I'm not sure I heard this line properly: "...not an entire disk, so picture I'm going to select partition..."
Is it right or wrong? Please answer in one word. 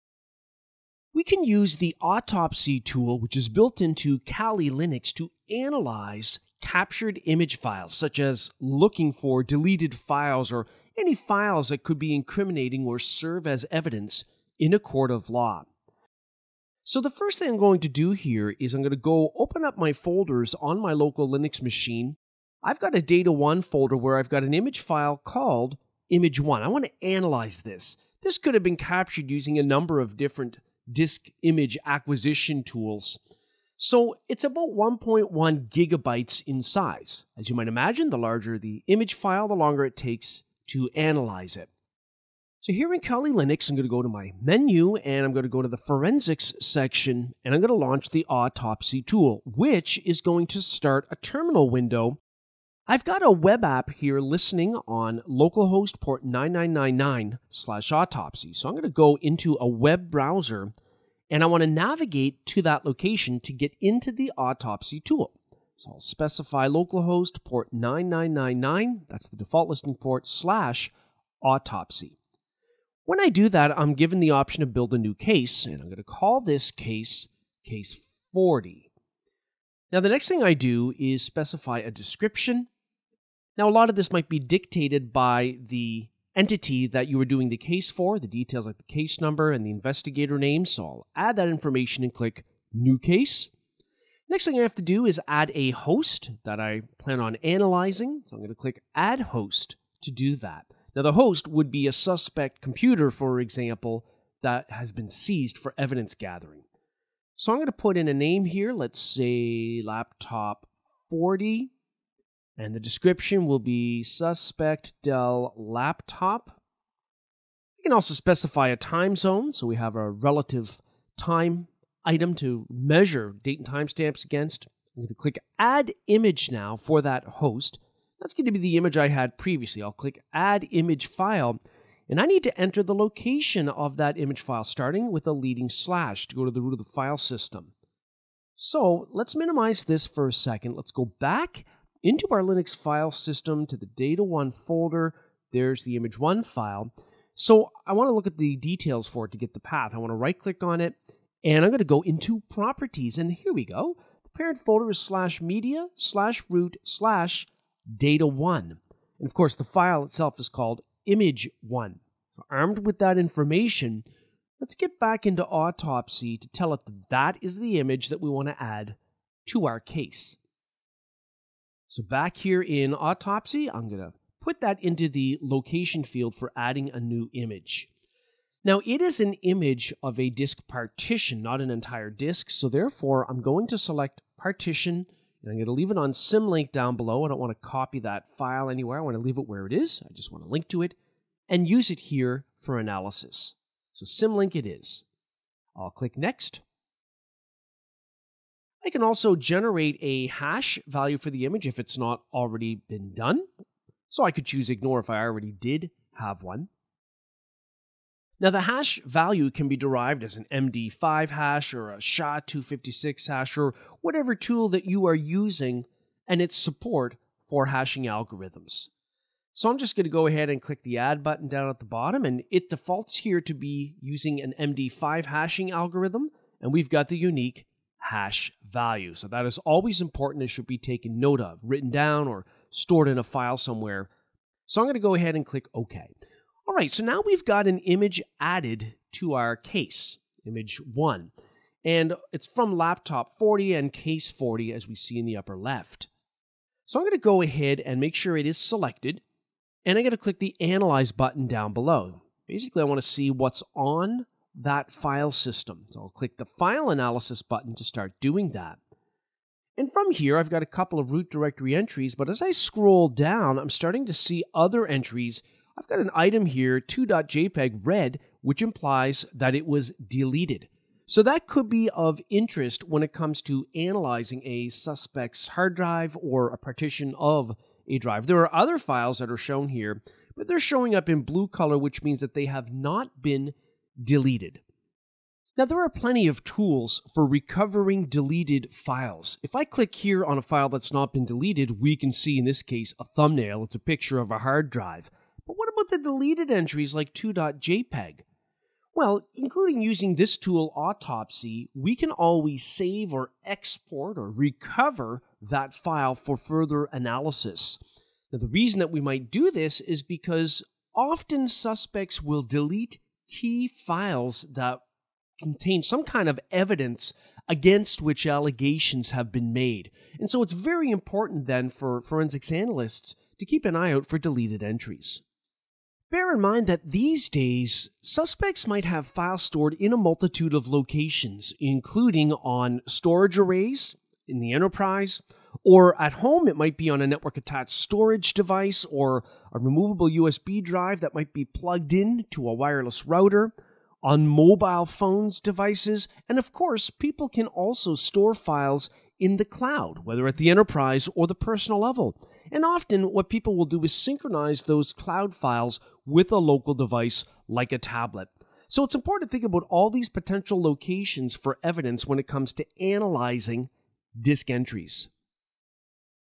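wrong.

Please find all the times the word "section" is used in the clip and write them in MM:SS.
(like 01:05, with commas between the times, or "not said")
00:46.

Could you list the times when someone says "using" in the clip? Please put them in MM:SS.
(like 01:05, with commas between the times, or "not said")
00:29, 03:35, 03:44, 04:59.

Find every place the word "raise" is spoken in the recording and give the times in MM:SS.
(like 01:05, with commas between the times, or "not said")
not said.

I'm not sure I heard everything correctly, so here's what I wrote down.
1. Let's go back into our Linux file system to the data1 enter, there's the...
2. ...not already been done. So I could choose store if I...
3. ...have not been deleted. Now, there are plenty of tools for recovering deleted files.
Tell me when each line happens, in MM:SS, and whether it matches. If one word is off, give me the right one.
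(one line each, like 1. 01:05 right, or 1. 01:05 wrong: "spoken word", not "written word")
1. 02:20 wrong: "folder", not "enter"
2. 03:21 wrong: "ignore", not "store"
3. 04:42 right.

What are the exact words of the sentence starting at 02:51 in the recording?
So back here in Autopsy, I'm going to put that into the location field for adding a new image.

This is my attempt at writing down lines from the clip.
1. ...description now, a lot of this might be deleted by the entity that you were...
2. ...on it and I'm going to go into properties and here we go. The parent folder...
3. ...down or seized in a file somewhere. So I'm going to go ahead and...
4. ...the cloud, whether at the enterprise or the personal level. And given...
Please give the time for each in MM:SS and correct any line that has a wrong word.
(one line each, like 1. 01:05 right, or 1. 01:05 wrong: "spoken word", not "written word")
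1. 01:21 wrong: "dictated", not "deleted"
2. 02:30 right
3. 03:51 wrong: "stored", not "seized"
4. 05:49 wrong: "often", not "given".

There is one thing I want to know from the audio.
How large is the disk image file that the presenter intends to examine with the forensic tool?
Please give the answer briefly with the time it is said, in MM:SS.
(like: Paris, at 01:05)
1.1 gigabytes, at 00:34.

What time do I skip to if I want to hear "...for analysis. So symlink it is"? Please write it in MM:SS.
03:12.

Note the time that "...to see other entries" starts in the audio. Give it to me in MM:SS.
04:24.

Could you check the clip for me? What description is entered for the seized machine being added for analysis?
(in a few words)
Suspect Dell Laptop.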